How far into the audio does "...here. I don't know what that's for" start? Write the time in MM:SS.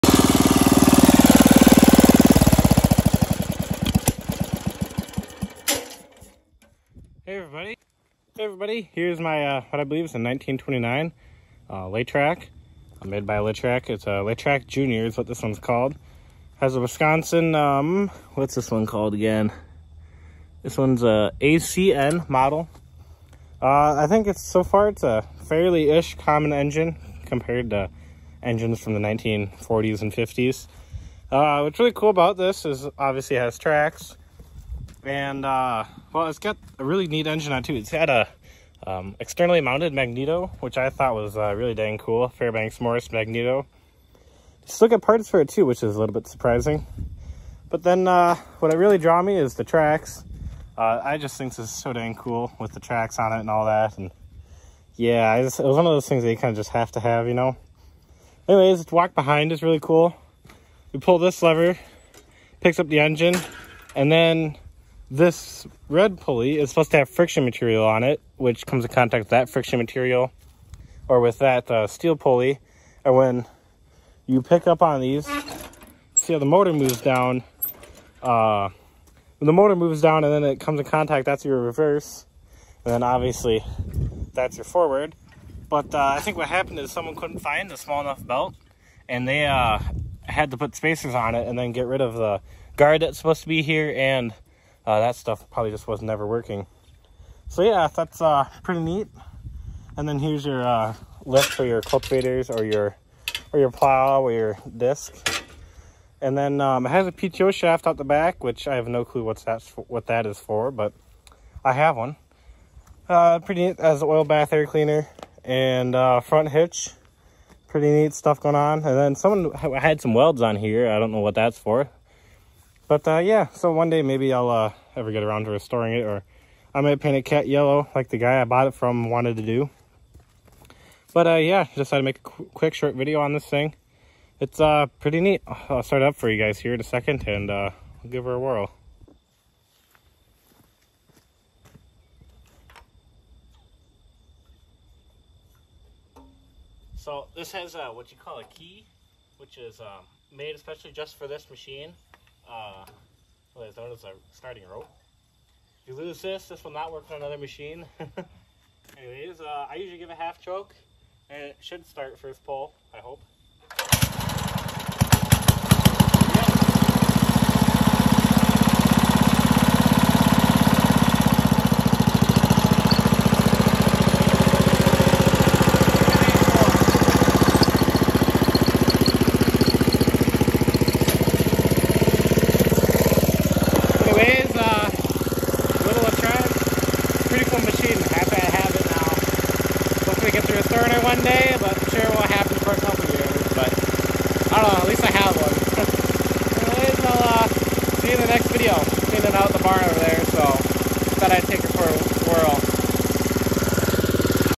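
02:00.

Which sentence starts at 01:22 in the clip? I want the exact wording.
And then obviously that's your forward.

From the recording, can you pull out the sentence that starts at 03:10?
Hopefully get through a third one day, but I'm sure won't happen for a couple years.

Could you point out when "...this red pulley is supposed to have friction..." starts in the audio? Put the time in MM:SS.
01:05.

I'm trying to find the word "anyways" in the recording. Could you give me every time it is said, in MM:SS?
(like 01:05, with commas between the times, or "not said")
00:58, 02:38, 03:16.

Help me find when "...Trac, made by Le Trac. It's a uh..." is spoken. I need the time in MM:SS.
00:12.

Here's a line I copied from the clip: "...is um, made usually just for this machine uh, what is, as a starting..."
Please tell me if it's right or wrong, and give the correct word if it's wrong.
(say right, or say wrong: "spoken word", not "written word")
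wrong: "especially", not "usually".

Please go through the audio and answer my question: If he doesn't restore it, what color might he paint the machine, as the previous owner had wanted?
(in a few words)
Cat yellow.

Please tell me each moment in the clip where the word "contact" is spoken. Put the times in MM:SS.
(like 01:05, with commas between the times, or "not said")
01:08, 01:20.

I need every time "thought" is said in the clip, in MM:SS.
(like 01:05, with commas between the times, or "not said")
00:40, 03:21.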